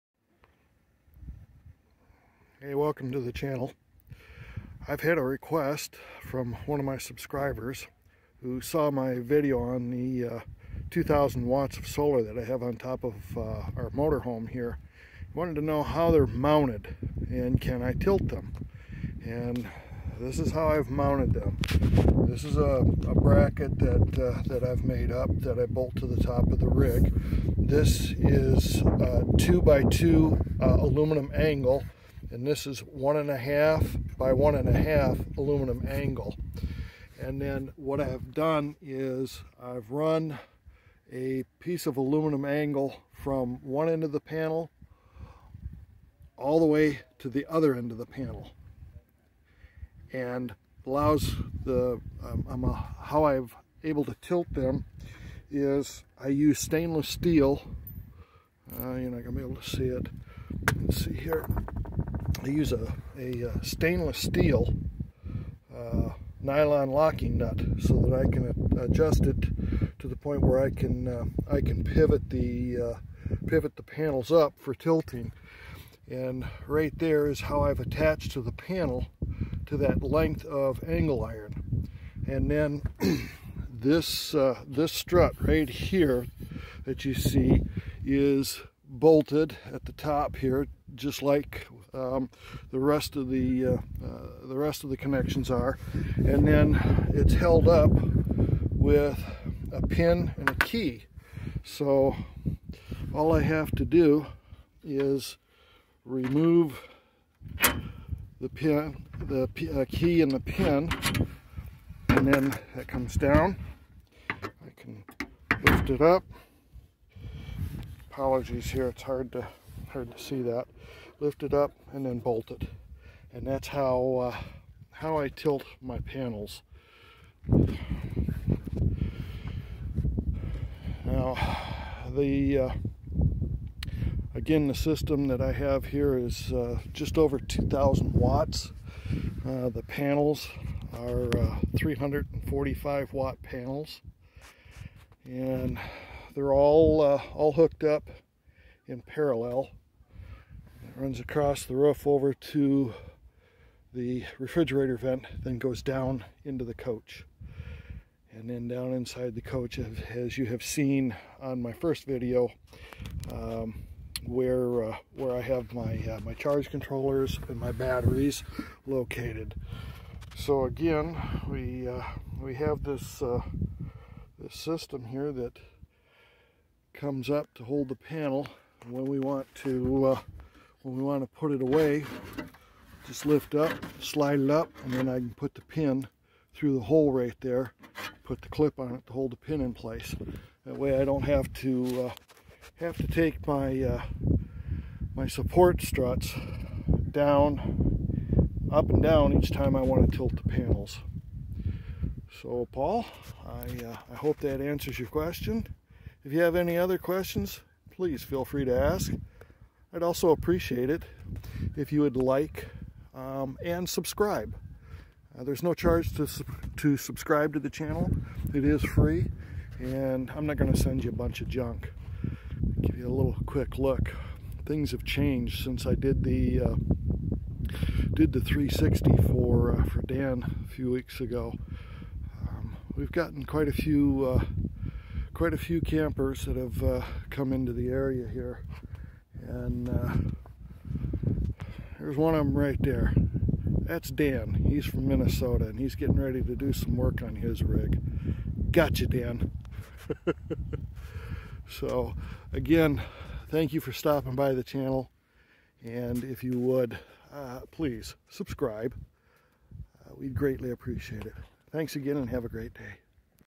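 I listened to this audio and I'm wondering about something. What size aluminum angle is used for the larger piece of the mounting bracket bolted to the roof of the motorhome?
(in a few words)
2 by 2.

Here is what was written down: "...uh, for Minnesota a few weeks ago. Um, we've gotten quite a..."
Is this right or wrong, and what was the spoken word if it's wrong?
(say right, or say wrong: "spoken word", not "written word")
wrong: "Dan", not "Minnesota".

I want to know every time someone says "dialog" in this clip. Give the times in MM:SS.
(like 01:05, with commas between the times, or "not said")
not said.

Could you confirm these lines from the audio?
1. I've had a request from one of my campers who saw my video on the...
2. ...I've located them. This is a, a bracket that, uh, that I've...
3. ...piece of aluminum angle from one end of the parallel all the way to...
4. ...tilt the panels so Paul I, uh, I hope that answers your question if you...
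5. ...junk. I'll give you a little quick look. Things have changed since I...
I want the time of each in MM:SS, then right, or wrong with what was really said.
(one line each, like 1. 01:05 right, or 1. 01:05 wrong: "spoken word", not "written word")
1. 00:04 wrong: "subscribers", not "campers"
2. 00:20 wrong: "mounted", not "located"
3. 00:41 wrong: "panel", not "parallel"
4. 03:20 right
5. 03:41 right.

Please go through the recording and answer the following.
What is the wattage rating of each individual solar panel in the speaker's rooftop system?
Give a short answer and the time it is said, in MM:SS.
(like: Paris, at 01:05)
345 watts, at 02:21.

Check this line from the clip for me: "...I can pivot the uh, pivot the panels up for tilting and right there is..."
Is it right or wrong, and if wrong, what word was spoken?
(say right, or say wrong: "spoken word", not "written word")
right.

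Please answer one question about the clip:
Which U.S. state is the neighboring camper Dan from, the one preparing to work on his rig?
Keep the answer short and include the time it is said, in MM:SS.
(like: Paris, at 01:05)
Minnesota, at 04:05.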